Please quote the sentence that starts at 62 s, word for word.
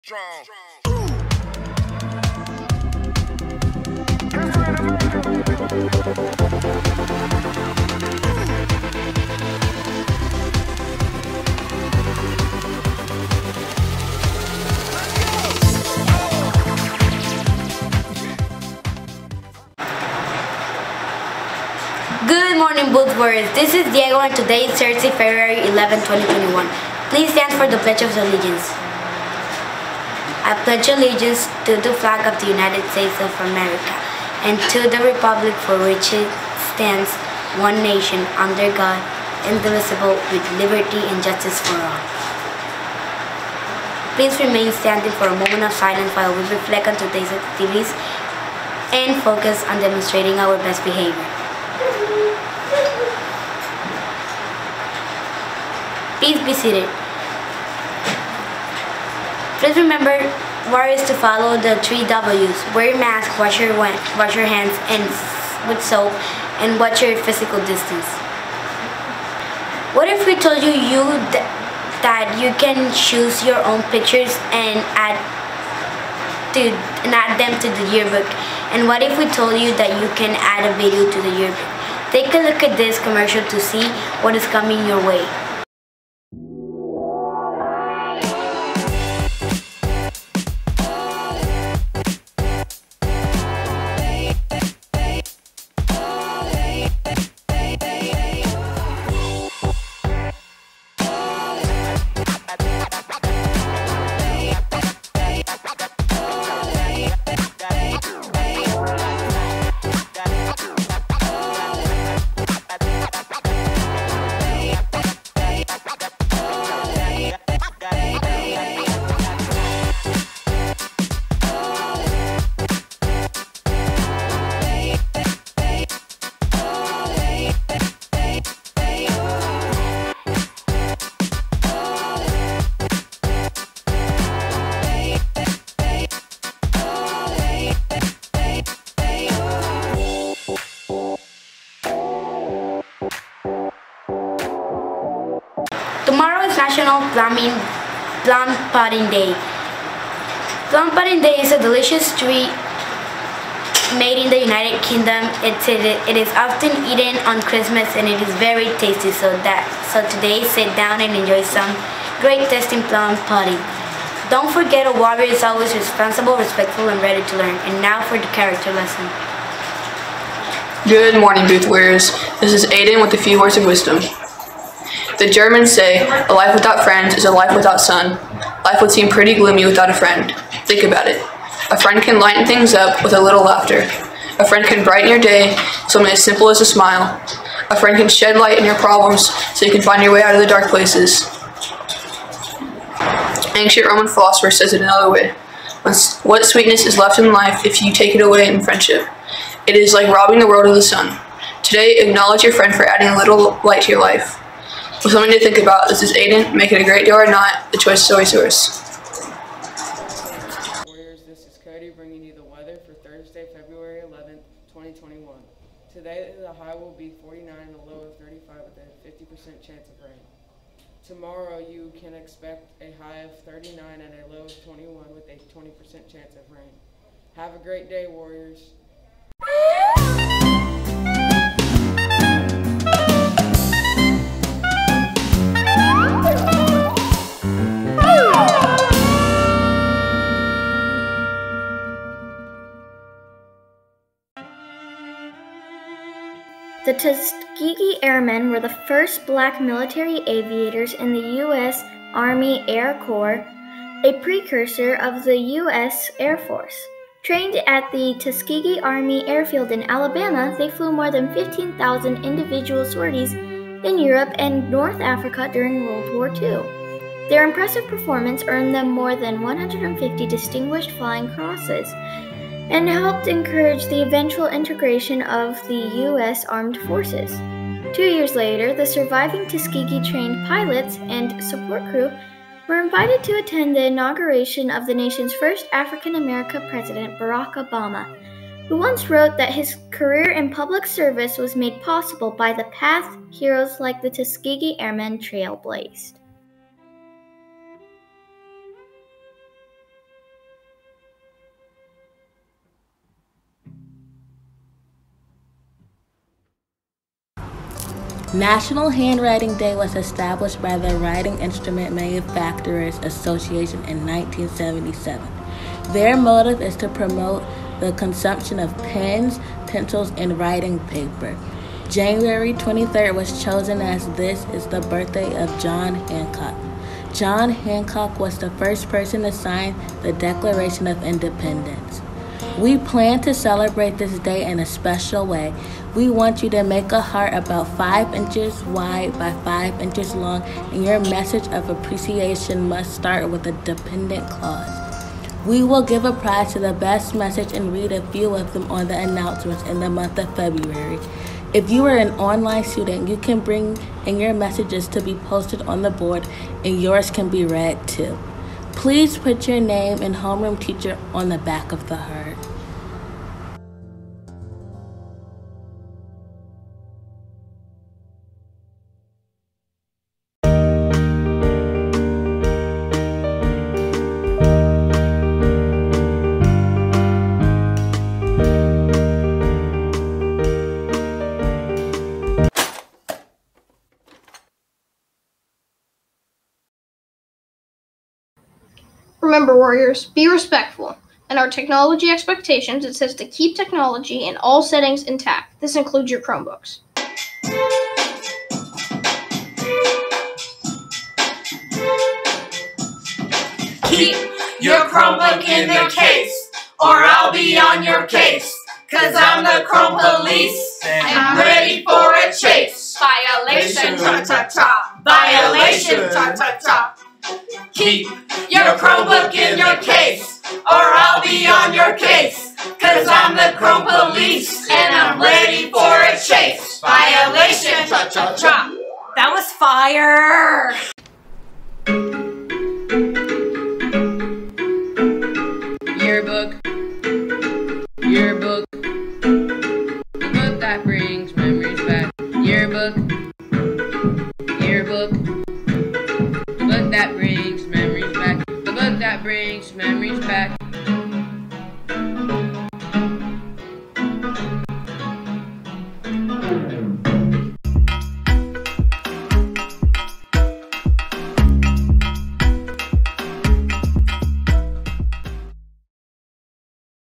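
Wear your mask, wash your, wash your hands and with soap, and watch your physical distance.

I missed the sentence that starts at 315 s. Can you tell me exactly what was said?
Their motive is to promote the consumption of pens, pencils, and writing paper.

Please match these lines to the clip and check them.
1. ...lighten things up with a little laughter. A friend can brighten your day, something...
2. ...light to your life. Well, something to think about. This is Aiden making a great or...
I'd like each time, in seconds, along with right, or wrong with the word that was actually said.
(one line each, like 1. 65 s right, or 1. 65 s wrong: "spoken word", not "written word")
1. 182 s right
2. 203 s right.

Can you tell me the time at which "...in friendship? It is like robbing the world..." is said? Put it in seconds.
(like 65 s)
198 s.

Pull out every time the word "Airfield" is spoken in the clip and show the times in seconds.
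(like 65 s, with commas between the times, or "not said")
259 s.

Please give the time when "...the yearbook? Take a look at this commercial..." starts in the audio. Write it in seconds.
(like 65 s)
81 s.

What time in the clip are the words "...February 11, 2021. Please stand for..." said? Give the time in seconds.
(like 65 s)
25 s.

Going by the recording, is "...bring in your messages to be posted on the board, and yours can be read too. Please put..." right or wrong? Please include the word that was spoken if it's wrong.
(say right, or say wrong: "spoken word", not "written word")
right.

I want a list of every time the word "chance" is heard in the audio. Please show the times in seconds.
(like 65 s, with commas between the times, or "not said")
219 s, 226 s.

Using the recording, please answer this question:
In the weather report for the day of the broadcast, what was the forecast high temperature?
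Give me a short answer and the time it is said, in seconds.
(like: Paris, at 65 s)
49, at 217 s.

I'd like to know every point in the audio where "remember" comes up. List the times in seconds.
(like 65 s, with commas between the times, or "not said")
59 s, 389 s.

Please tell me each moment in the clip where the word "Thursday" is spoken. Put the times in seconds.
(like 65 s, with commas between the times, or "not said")
24 s, 212 s.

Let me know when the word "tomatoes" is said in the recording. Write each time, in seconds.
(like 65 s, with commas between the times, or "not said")
not said.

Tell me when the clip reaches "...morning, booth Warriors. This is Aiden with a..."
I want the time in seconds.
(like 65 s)
171 s.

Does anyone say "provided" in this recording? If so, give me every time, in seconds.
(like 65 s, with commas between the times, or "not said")
not said.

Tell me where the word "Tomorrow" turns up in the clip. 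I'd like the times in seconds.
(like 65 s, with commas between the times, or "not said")
146 s, 221 s.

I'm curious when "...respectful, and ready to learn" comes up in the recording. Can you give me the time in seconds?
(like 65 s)
166 s.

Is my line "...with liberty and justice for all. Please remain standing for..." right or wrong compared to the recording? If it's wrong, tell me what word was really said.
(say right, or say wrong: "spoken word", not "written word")
right.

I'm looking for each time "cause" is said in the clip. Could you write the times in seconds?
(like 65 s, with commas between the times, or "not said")
408 s, 422 s.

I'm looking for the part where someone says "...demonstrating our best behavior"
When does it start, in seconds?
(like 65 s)
49 s.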